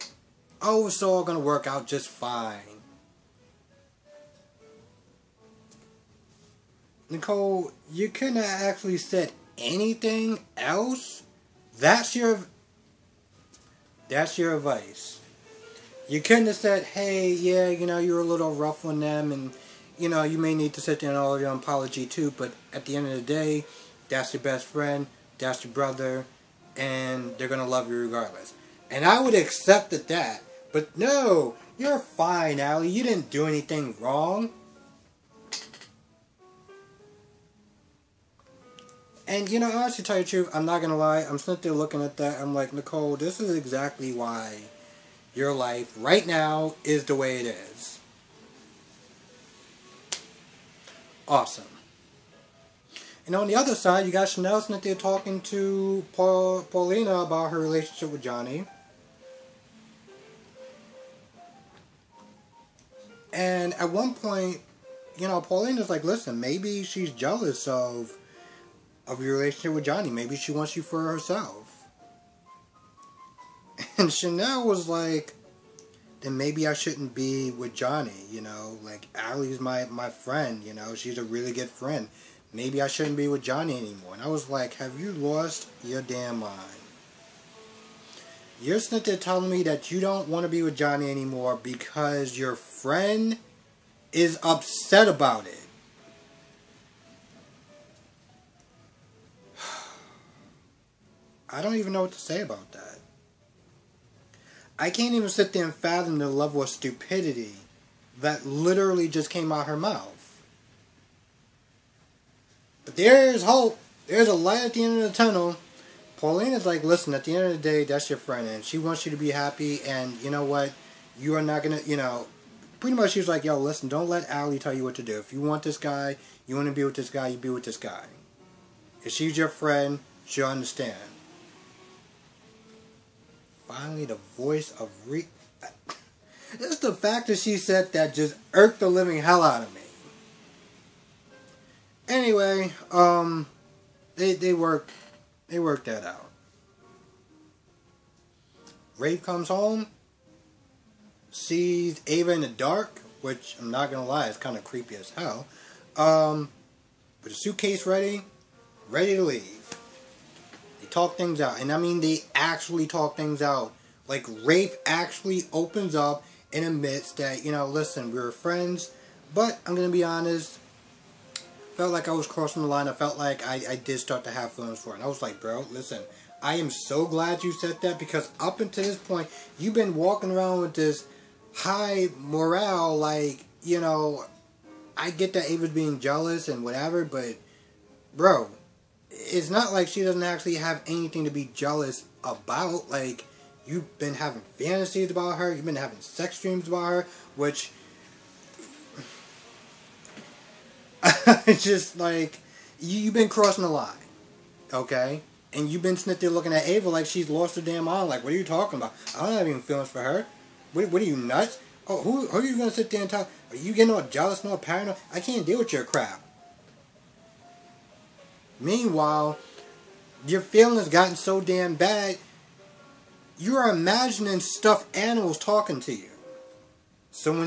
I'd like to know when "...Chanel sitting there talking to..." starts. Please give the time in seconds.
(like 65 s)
54 s.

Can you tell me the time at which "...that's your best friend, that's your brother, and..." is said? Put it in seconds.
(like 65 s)
24 s.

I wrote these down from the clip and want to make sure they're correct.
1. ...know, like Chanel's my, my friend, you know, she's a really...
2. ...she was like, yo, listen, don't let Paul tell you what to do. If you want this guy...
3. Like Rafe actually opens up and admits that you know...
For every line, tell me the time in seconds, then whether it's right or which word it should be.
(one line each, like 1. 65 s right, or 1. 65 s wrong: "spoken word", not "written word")
1. 78 s wrong: "Allie", not "Chanel"
2. 123 s wrong: "Allie", not "Paul"
3. 164 s right.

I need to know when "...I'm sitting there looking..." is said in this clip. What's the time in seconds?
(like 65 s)
41 s.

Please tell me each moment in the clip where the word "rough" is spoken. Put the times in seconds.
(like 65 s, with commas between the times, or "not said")
18 s.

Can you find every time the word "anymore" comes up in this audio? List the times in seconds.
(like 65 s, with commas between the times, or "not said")
83 s, 91 s.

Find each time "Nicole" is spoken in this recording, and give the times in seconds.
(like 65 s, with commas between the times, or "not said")
7 s, 42 s.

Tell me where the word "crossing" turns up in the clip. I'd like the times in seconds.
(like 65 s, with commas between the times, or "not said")
172 s, 203 s.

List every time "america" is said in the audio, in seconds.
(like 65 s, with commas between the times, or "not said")
not said.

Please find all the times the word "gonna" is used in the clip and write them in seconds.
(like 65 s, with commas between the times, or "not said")
40 s, 121 s, 153 s, 169 s, 212 s.